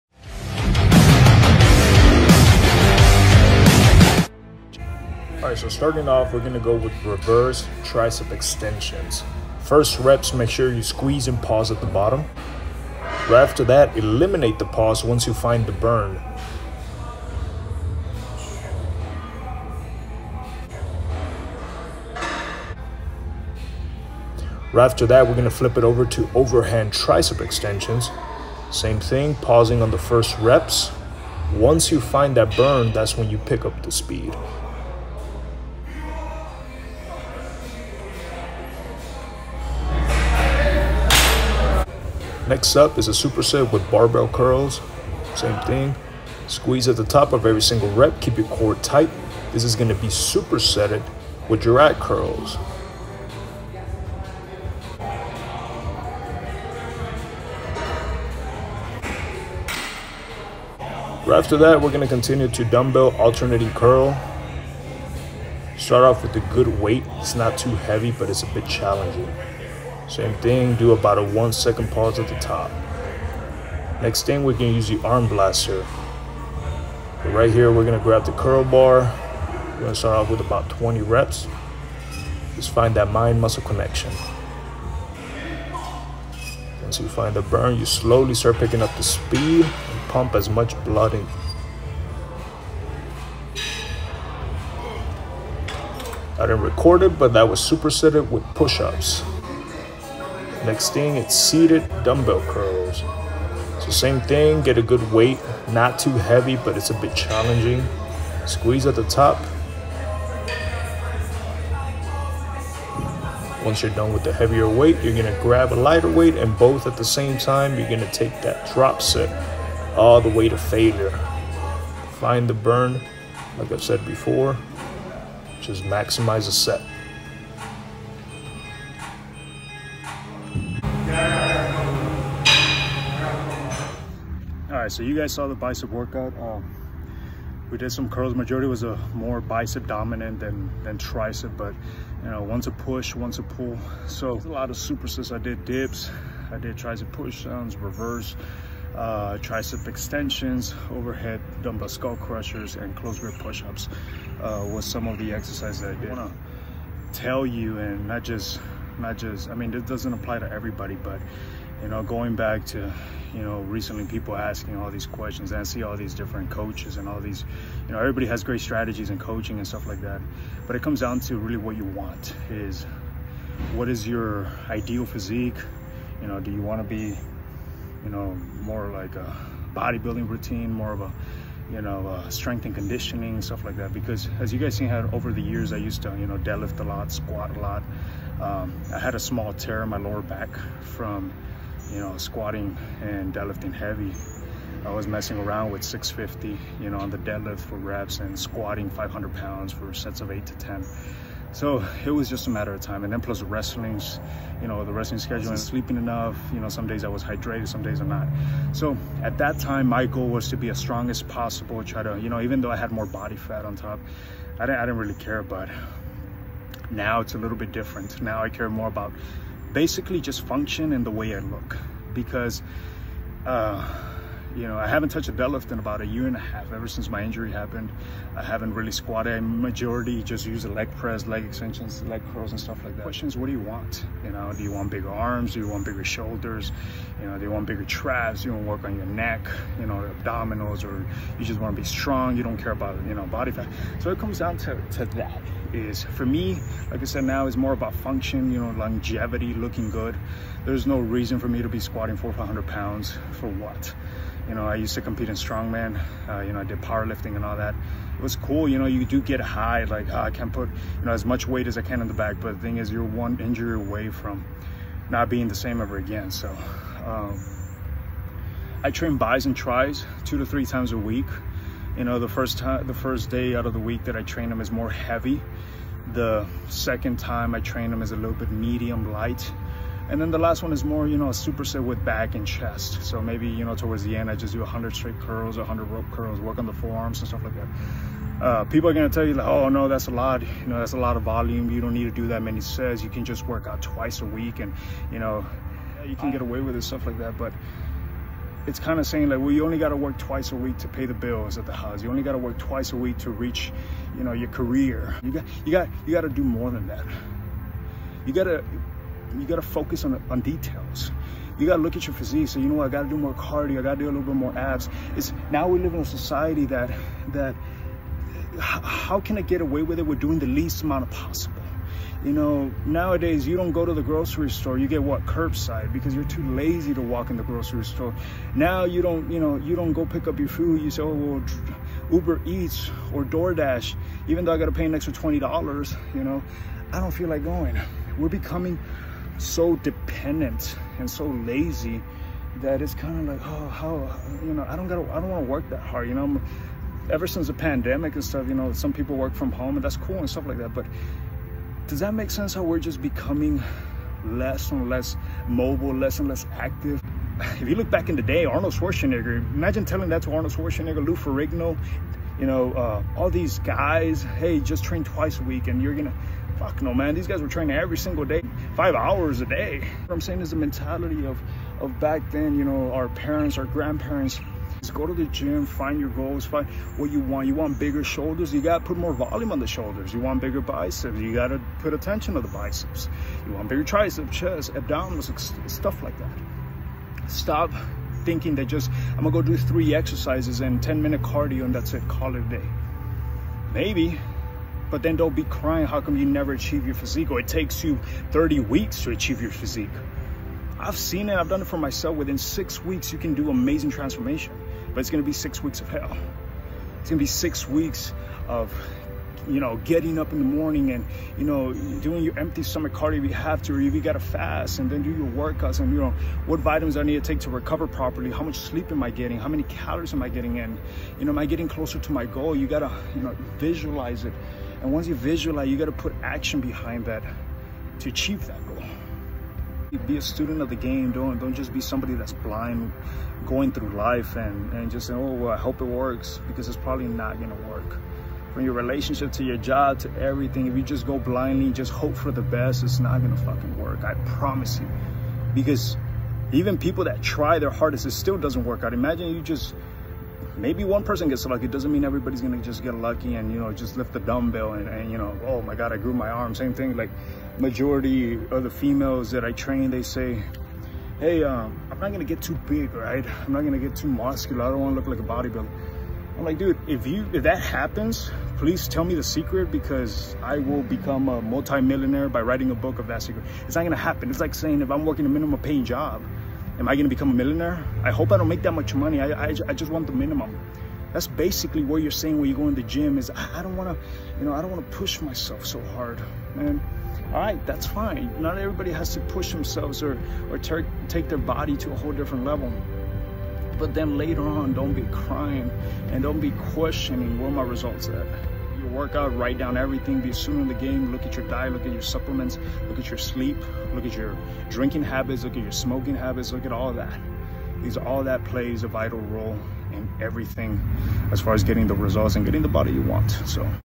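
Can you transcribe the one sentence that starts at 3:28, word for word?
So at that time, my goal was to be as strong as possible.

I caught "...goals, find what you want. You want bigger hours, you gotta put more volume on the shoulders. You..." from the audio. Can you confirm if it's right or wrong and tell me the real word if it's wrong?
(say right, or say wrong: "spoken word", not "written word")
wrong: "shoulders", not "hours".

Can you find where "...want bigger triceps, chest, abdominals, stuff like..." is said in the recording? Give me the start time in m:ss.
6:23.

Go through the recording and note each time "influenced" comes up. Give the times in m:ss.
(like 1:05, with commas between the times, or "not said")
not said.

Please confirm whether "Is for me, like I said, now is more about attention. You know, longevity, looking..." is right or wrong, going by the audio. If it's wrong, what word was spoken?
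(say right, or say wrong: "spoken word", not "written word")
wrong: "function", not "attention".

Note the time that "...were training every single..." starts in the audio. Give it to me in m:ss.
6:07.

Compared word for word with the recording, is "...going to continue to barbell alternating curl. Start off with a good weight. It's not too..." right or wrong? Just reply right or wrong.
wrong.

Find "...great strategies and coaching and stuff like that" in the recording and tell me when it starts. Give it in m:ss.
2:48.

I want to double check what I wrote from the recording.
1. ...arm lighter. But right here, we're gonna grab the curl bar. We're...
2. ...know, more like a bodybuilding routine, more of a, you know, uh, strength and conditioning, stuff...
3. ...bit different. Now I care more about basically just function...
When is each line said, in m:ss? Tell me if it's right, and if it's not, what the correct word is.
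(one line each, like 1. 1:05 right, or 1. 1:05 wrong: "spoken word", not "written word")
1. 1:15 wrong: "blaster", not "lighter"
2. 2:58 right
3. 3:37 right.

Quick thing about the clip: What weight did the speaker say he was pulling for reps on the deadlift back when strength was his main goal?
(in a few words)
650.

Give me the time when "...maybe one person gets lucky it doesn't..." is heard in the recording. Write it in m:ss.
7:30.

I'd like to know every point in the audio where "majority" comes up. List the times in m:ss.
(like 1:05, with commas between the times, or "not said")
2:18, 3:49, 7:37.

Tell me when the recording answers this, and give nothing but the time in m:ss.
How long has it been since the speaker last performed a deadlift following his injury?
3:45.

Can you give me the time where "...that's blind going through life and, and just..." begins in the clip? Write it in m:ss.
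7:12.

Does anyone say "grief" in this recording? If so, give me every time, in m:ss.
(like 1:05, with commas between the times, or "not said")
not said.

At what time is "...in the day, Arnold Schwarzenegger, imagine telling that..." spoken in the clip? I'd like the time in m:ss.
5:58.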